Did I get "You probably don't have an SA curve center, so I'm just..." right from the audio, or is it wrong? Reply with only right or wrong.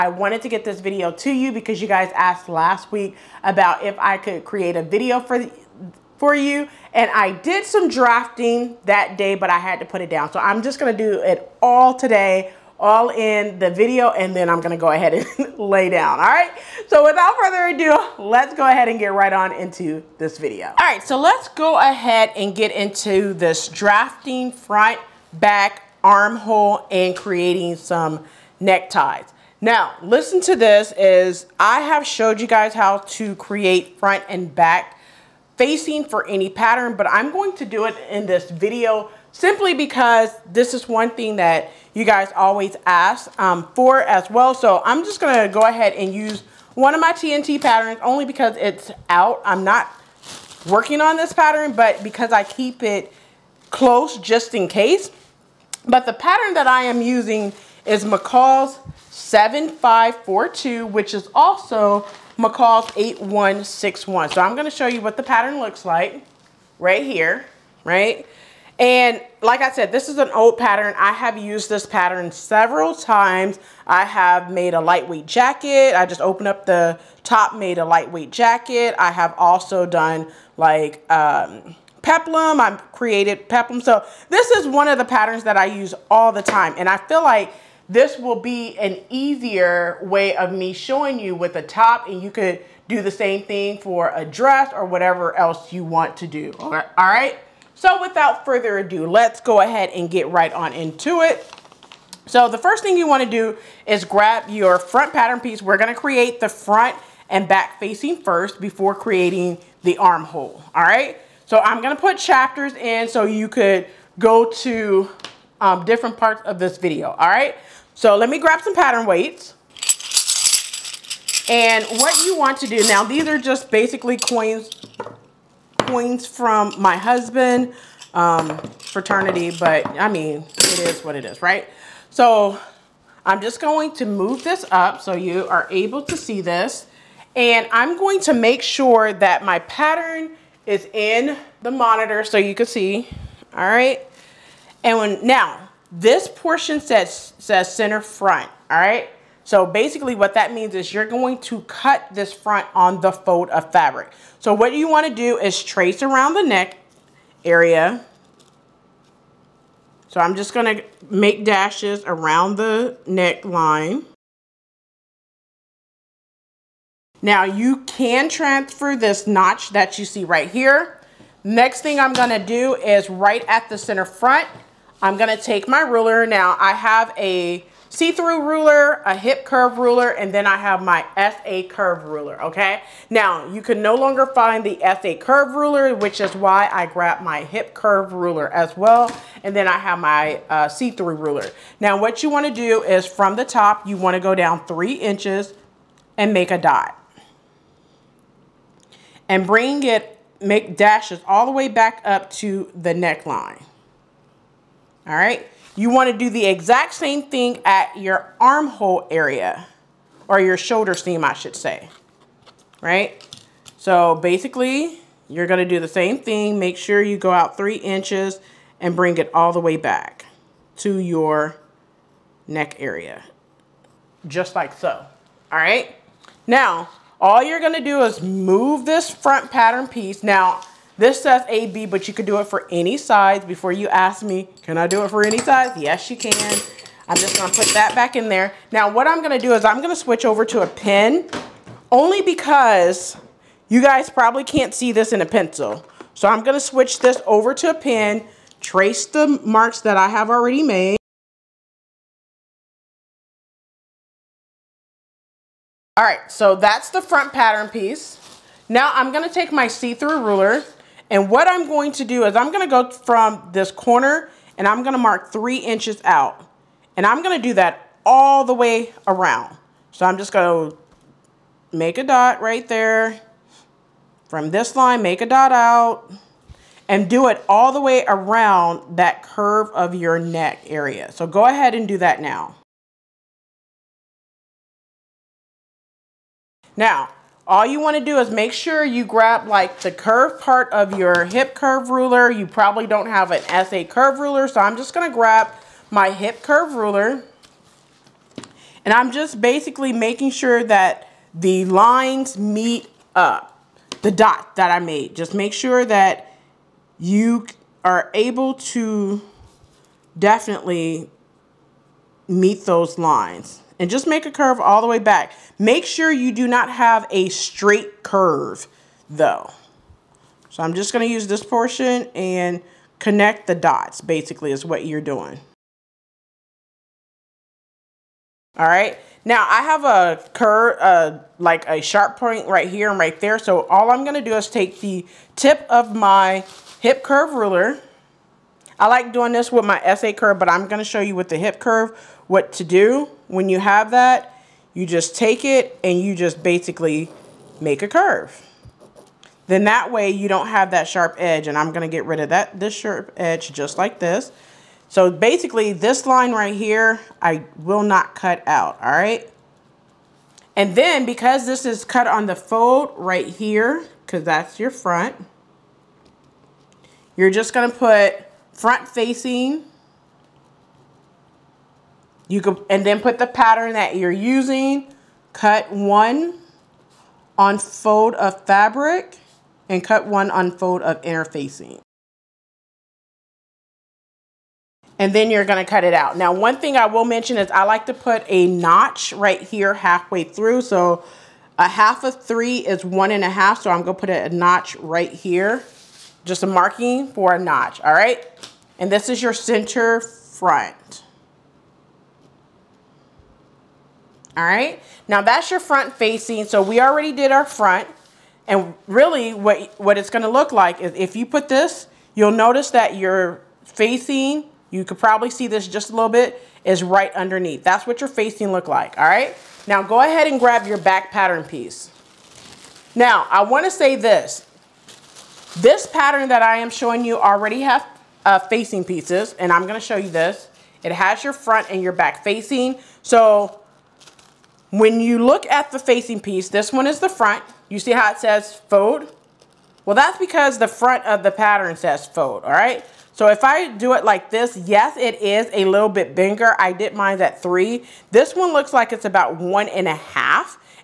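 wrong.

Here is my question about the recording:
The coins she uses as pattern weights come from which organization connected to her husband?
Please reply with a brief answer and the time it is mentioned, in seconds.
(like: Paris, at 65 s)
fraternity, at 128 s.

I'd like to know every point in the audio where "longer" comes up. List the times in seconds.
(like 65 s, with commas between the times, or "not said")
183 s.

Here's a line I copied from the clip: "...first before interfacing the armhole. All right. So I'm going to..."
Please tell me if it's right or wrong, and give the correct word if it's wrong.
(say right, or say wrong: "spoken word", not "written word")
wrong: "creating", not "interfacing".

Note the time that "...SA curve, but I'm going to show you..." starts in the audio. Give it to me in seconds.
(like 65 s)
339 s.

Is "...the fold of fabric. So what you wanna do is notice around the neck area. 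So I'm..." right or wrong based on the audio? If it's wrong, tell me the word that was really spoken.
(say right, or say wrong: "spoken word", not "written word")
wrong: "trace", not "notice".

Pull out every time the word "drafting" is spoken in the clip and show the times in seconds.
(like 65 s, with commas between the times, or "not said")
7 s, 23 s.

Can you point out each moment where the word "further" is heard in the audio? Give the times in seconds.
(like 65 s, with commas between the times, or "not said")
17 s, 98 s.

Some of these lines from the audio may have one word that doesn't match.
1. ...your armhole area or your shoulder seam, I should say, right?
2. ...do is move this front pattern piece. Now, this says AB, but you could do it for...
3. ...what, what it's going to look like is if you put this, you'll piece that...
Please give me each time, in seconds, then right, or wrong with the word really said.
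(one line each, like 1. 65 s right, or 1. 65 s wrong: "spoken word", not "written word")
1. 207 s right
2. 227 s right
3. 409 s wrong: "notice", not "piece".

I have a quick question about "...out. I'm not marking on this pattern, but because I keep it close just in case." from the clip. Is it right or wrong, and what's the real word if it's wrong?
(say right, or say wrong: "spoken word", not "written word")
wrong: "working", not "marking".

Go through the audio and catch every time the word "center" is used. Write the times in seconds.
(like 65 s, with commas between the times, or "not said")
147 s, 173 s, 399 s.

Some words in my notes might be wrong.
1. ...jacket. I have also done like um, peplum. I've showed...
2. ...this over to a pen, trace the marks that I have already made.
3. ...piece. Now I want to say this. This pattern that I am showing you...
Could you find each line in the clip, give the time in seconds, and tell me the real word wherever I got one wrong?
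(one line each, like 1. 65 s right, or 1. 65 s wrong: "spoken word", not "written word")
1. 78 s wrong: "created", not "showed"
2. 246 s right
3. 421 s right.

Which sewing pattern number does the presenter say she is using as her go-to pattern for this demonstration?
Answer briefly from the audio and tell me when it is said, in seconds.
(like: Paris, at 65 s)
McCall's 7542, at 58 s.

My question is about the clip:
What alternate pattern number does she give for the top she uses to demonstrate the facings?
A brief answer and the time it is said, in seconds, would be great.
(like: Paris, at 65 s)
McCall's 8161, at 62 s.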